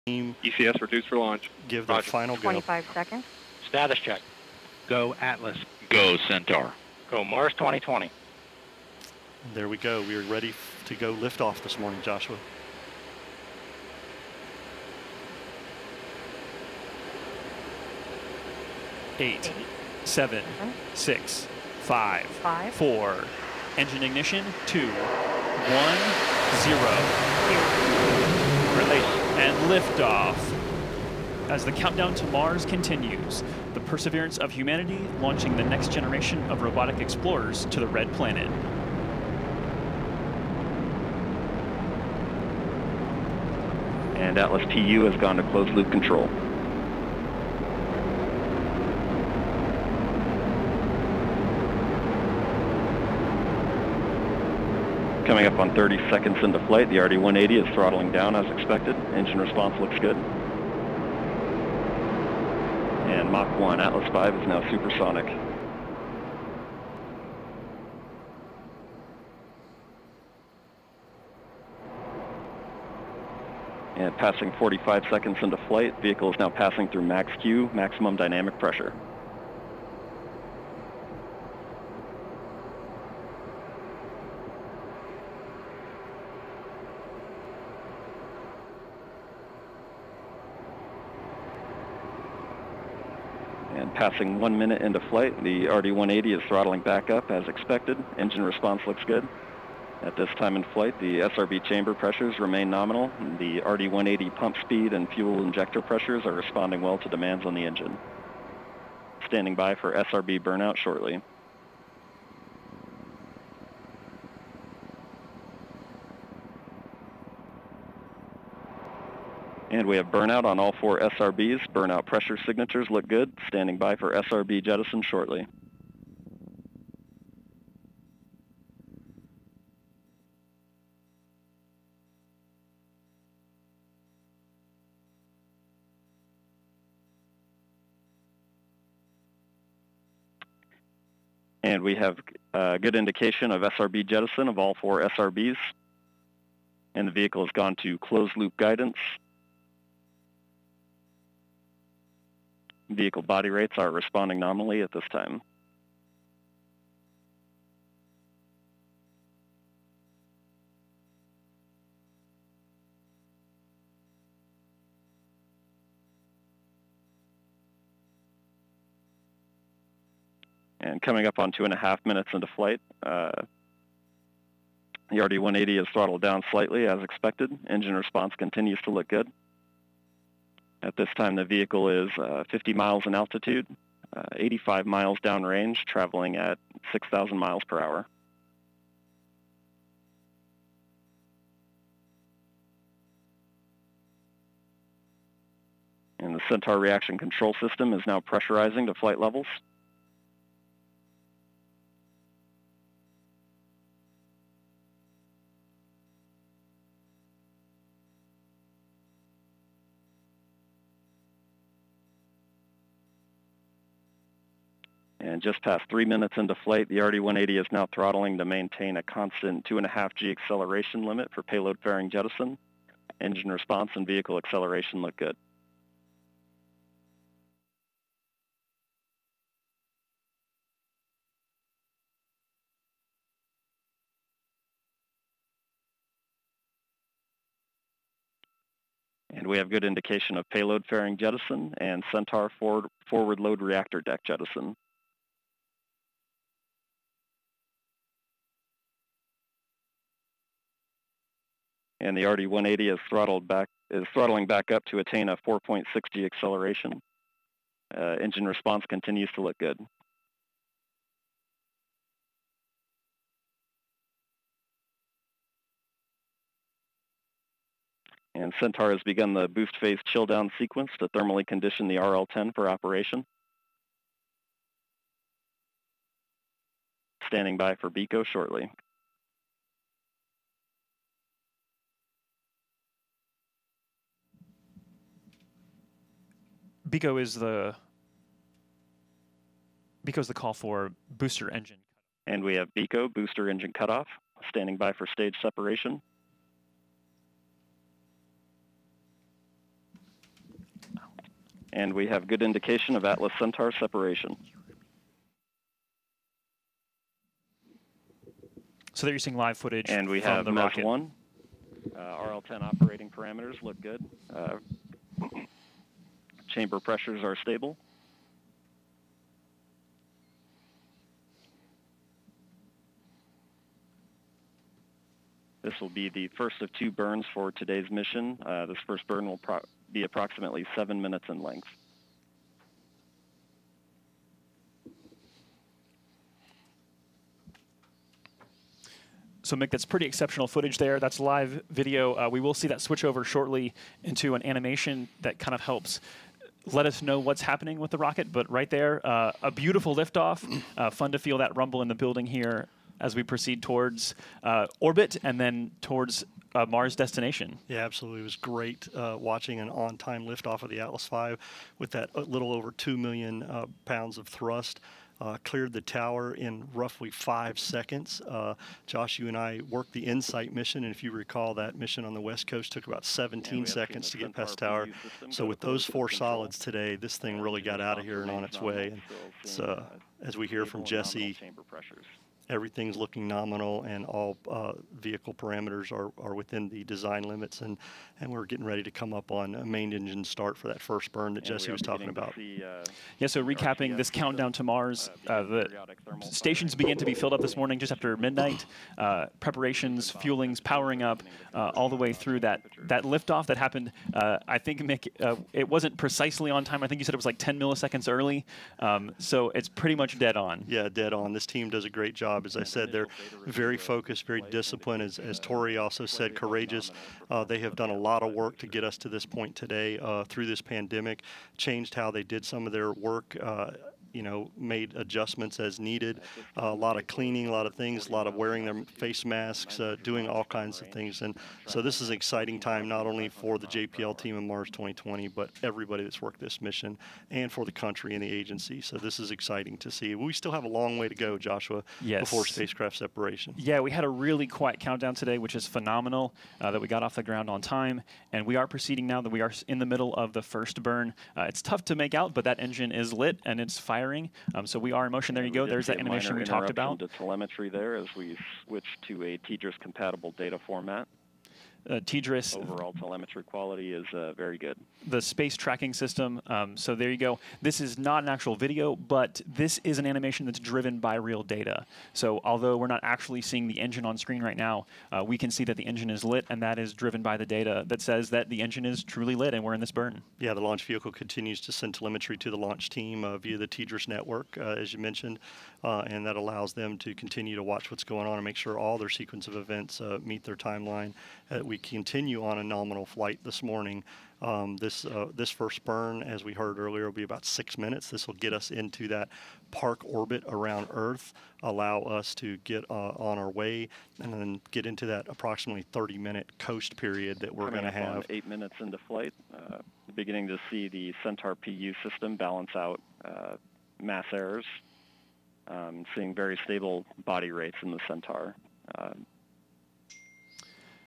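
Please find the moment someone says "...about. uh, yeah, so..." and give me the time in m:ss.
6:32.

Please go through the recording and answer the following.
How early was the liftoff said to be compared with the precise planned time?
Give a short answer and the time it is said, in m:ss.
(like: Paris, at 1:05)
10 milliseconds, at 6:47.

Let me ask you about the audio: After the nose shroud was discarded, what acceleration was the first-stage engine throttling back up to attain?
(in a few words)
4.6G.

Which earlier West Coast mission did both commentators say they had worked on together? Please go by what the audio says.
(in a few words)
InSight.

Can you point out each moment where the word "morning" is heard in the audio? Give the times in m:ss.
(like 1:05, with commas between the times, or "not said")
0:11, 6:37, 8:13.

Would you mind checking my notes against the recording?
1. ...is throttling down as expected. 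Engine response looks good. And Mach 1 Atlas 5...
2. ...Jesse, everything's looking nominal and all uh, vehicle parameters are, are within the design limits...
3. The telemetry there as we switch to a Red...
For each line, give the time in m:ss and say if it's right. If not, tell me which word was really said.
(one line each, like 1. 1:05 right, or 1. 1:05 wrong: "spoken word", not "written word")
1. 0:57 right
2. 6:20 right
3. 7:36 wrong: "TDRS", not "Red".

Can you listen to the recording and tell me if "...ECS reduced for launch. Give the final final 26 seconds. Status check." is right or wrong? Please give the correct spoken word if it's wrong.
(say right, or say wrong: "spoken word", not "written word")
wrong: "25", not "26".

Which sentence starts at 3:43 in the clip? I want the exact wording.
Engine response and vehicle acceleration look good.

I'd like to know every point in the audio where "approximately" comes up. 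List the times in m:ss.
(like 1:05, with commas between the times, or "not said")
5:30, 8:25.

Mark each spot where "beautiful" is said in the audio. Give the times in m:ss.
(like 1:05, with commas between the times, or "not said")
5:49.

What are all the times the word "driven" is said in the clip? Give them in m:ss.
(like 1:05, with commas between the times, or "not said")
7:50, 7:56.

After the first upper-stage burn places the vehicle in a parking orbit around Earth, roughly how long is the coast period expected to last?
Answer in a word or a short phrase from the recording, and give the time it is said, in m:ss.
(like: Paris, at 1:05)
30 minutes, at 8:25.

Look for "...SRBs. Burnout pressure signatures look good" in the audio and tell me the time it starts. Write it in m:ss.
2:00.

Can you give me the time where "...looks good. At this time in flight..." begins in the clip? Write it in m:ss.
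1:38.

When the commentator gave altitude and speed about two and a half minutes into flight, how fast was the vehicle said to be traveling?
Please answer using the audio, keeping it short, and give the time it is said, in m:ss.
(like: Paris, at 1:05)
6,000 miles per hour, at 3:06.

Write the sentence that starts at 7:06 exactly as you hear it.
Uh, a lot of cleaning, a lot of things, a lot of wearing their face masks, uh, doing all kinds of things.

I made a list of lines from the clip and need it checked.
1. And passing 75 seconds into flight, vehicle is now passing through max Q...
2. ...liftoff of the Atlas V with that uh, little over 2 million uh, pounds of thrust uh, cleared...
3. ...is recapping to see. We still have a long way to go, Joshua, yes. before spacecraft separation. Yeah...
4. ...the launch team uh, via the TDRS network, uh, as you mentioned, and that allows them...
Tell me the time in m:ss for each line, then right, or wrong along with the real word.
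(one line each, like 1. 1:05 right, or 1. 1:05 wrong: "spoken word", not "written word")
1. 1:13 wrong: "45", not "75"
2. 6:00 right
3. 7:19 wrong: "exciting", not "recapping"
4. 8:02 right.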